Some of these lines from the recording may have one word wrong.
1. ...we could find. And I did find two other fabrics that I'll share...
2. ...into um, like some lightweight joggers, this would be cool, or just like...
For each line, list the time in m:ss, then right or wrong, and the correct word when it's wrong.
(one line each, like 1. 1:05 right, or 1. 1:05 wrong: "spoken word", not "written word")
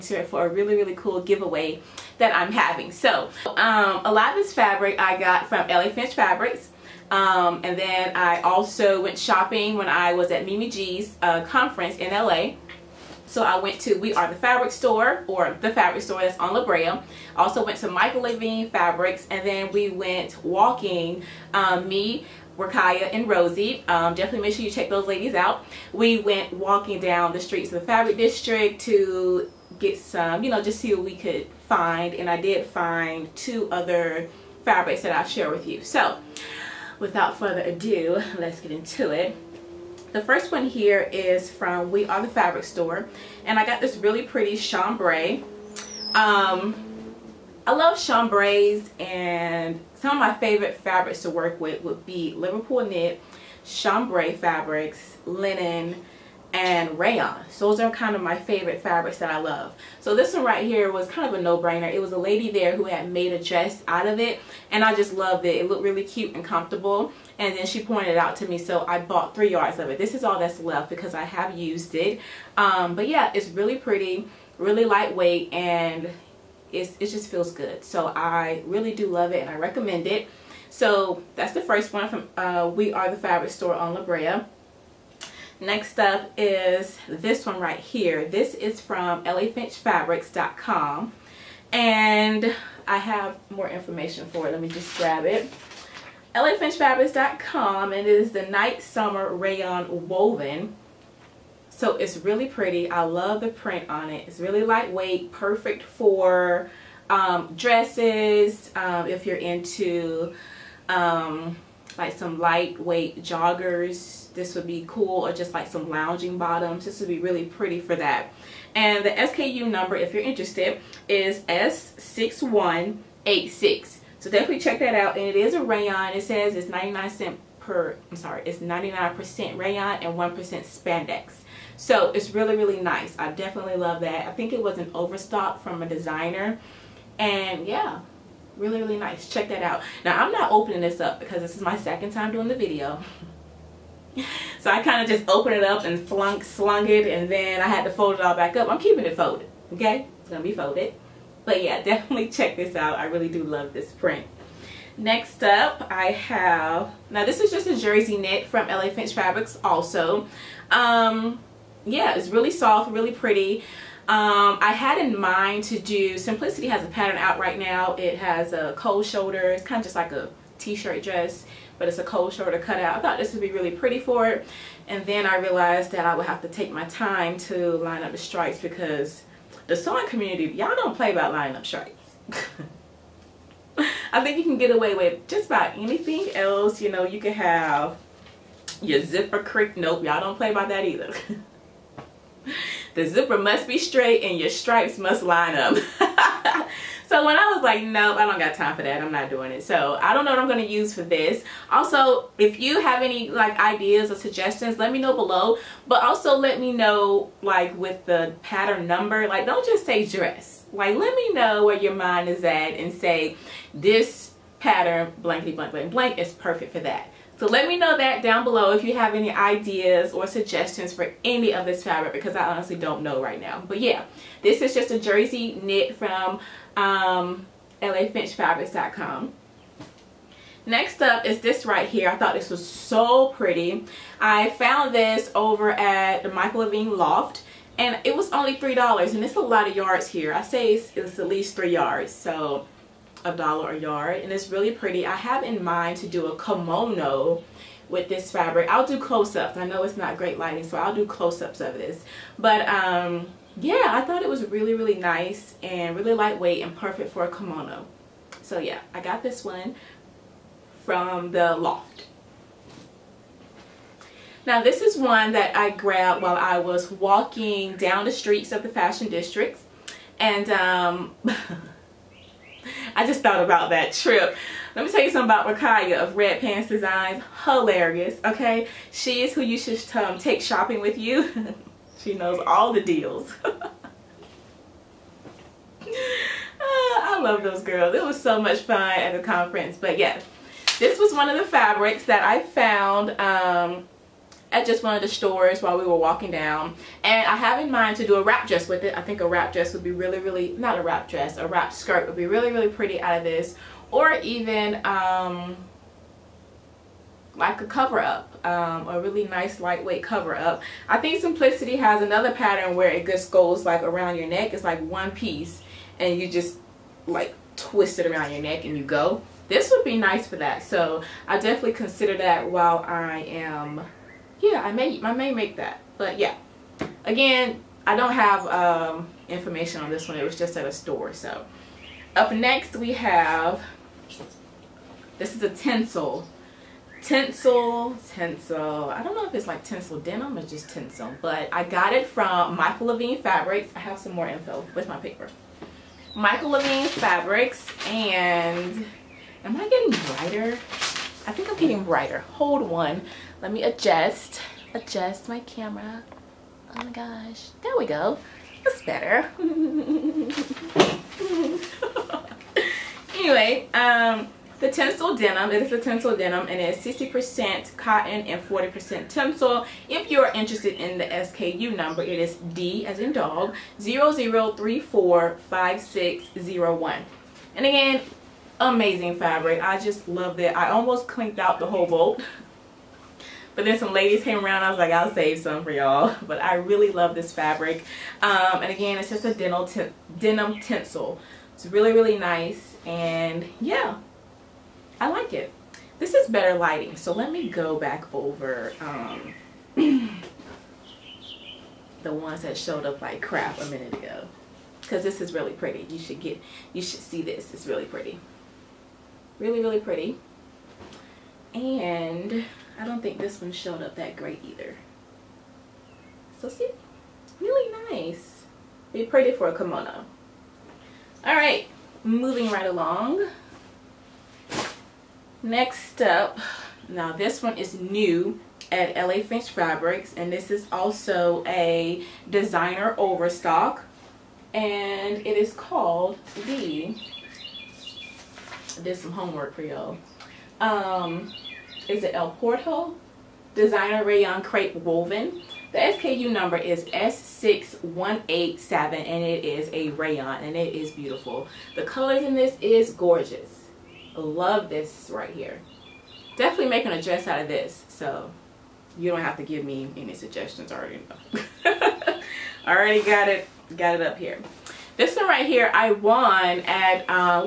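1. 0:31 right
2. 1:49 right.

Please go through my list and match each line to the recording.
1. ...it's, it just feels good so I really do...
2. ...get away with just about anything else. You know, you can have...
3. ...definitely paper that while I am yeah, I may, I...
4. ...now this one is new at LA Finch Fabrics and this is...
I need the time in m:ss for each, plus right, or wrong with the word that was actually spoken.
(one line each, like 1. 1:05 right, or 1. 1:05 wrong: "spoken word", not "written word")
1. 1:16 right
2. 3:04 right
3. 5:21 wrong: "consider", not "paper"
4. 7:06 right.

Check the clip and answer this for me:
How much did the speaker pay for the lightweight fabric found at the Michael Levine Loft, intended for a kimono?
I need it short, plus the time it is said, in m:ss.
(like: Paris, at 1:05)
$3, at 3:58.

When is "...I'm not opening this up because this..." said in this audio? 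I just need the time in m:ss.
2:20.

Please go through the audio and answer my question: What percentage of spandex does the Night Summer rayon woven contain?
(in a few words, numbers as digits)
1%.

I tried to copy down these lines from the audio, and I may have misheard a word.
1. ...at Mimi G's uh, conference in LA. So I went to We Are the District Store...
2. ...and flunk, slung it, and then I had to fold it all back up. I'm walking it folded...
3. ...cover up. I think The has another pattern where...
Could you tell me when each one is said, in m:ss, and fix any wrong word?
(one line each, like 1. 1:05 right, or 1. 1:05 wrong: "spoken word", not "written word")
1. 0:10 wrong: "Fabric", not "District"
2. 2:25 wrong: "keeping", not "walking"
3. 5:10 wrong: "Simplicity", not "The".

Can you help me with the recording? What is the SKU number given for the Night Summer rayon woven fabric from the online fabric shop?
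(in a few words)
S6186.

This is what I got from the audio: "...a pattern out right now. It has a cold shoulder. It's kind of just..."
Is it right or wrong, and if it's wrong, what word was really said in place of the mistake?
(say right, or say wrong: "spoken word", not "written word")
right.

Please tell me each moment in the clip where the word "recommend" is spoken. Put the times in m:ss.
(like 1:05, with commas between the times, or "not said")
1:19.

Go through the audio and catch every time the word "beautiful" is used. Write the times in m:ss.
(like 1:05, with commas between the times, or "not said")
7:30.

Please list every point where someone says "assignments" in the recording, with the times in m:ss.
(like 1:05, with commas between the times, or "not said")
not said.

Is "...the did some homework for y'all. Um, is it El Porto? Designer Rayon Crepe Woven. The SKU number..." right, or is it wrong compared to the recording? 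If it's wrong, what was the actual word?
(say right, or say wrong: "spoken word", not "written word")
right.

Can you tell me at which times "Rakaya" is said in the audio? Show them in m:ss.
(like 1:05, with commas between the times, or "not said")
0:22, 4:35.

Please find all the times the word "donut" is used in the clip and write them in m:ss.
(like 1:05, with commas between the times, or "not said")
not said.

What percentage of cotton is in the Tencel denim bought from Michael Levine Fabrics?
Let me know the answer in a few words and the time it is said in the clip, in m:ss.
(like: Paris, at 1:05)
60%, at 6:06.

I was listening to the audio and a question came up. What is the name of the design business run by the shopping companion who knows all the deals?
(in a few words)
Red Pants Designs.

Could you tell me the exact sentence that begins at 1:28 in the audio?
This is from LAFinchFabrics.com and I have more information for it.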